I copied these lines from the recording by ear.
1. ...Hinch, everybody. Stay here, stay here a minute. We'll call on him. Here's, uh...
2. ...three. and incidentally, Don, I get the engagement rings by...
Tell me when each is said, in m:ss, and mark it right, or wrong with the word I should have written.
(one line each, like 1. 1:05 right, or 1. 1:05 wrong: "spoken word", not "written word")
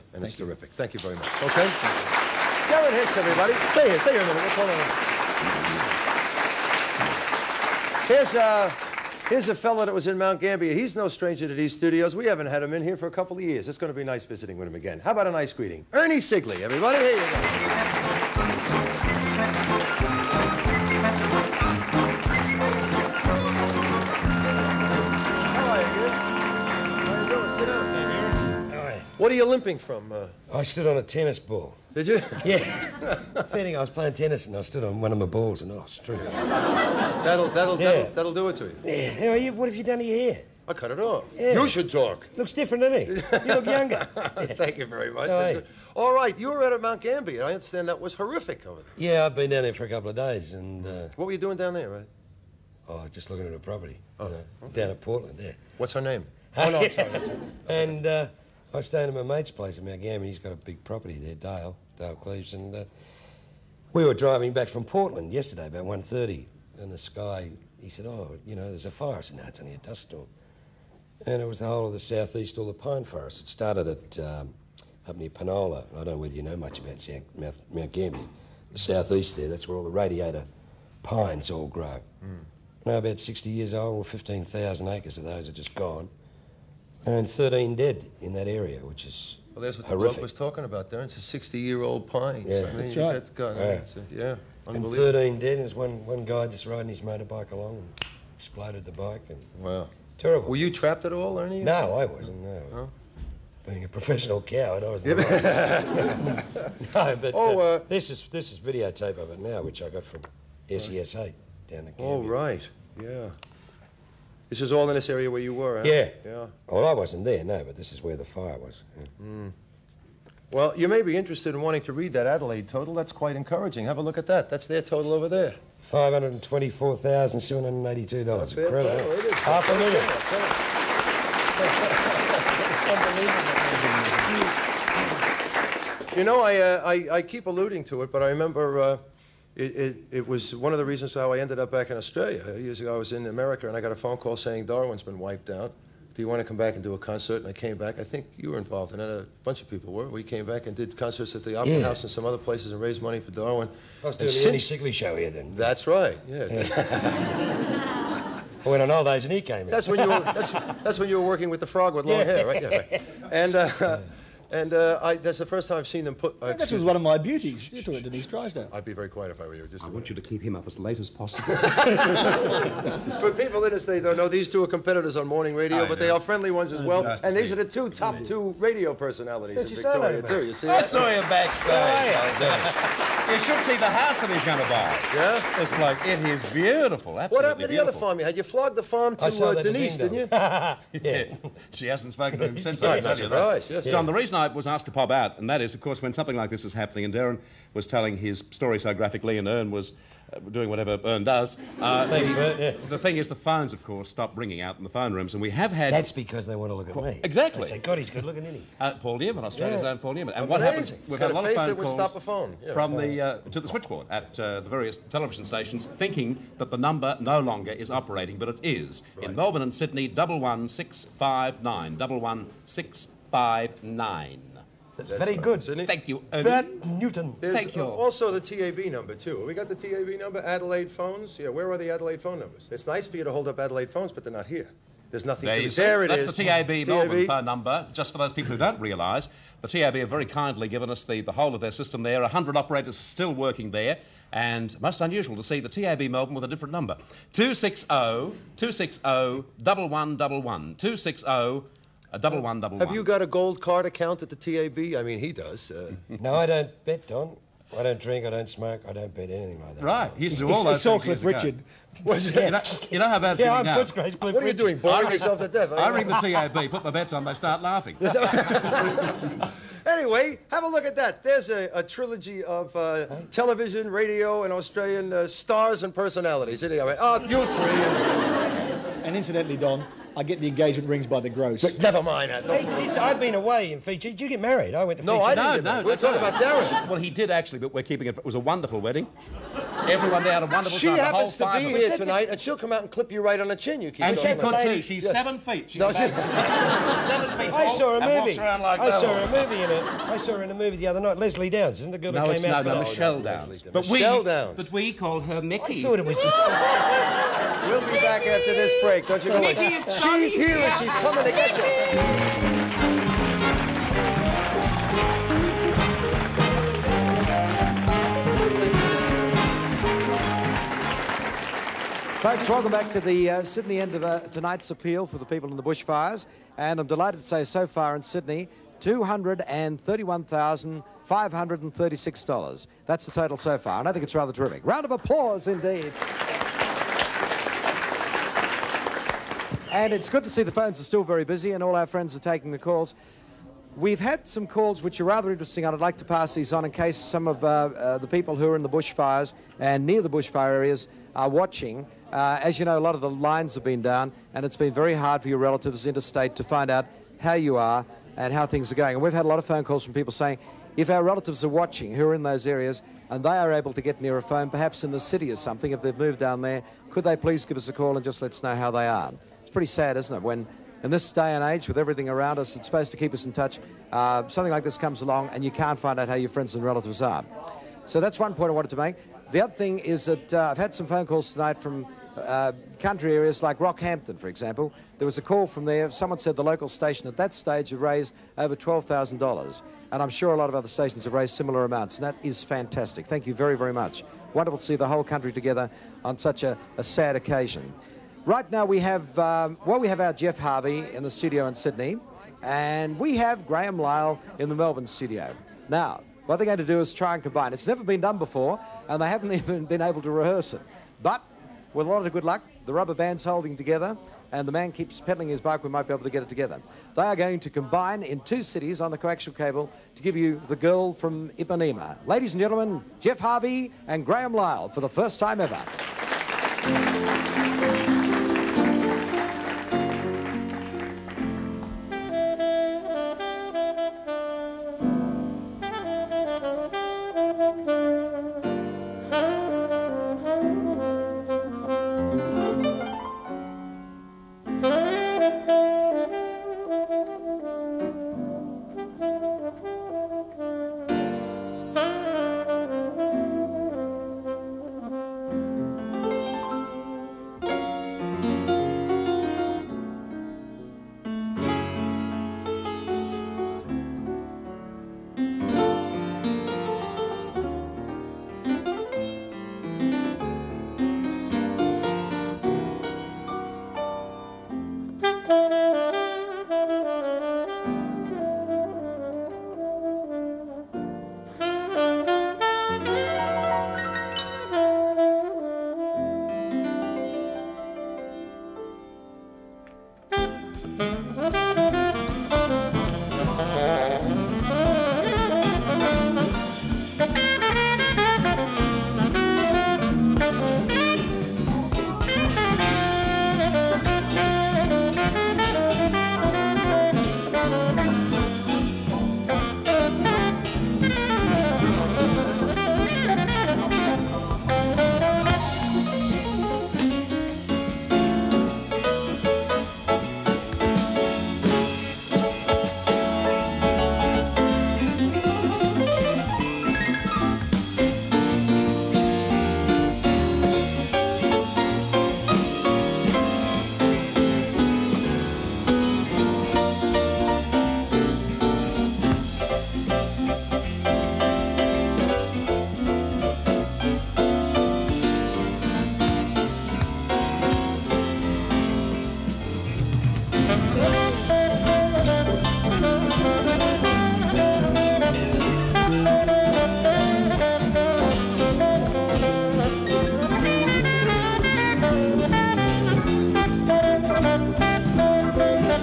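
1. 0:02 right
2. 4:38 right.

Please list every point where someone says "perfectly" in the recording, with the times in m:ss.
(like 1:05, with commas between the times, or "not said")
not said.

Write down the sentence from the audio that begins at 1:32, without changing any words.
Yeah, so, I mean, that's right.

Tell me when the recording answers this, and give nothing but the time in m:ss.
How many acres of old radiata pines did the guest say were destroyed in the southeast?
1:24.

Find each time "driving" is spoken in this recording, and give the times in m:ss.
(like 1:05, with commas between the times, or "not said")
1:04.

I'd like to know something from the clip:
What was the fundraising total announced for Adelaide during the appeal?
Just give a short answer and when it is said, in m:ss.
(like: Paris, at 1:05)
$524,782, at 2:05.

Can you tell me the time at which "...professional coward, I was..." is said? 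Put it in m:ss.
1:43.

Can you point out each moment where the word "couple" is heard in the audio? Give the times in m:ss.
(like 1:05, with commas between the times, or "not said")
0:13, 0:49.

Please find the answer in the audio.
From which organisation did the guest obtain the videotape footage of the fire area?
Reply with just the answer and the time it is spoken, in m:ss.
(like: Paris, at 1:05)
SESA, at 1:50.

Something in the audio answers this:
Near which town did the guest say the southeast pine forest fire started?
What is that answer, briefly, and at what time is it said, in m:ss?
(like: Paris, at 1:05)
Penola, at 1:15.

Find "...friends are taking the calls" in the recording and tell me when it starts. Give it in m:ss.
5:41.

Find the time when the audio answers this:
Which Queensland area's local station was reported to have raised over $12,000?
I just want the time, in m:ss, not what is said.
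6:23.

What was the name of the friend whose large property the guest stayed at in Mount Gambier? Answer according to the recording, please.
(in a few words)
Dale Cleves.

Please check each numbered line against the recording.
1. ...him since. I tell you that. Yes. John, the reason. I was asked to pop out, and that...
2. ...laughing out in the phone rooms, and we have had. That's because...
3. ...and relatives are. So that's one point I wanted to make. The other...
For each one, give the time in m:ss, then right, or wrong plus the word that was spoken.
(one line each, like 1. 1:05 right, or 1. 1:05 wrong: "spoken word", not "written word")
1. 3:12 right
2. 3:24 wrong: "ringing", not "laughing"
3. 6:16 right.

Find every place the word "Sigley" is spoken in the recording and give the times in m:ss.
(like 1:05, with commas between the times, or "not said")
0:16, 2:34.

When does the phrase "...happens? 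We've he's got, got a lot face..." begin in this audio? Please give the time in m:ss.
3:30.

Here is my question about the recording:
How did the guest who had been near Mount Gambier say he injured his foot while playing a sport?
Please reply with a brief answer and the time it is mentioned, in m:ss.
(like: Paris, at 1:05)
Stood on a tennis ball, at 0:30.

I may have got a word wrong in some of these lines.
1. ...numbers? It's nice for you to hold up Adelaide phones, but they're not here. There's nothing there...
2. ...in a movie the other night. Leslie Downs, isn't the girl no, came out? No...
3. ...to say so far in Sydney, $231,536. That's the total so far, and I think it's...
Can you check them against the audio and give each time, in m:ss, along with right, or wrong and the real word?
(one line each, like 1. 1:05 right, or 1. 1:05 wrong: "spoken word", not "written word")
1. 3:52 right
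2. 5:00 right
3. 5:27 right.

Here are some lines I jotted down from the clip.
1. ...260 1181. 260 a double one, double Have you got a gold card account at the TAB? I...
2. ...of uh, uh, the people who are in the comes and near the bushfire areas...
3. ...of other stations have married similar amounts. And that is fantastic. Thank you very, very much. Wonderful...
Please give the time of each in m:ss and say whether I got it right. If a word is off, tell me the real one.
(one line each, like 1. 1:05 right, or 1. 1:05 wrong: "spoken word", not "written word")
1. 4:07 wrong: "1111", not "1181"
2. 5:47 wrong: "bushfires", not "comes"
3. 6:30 wrong: "raised", not "married".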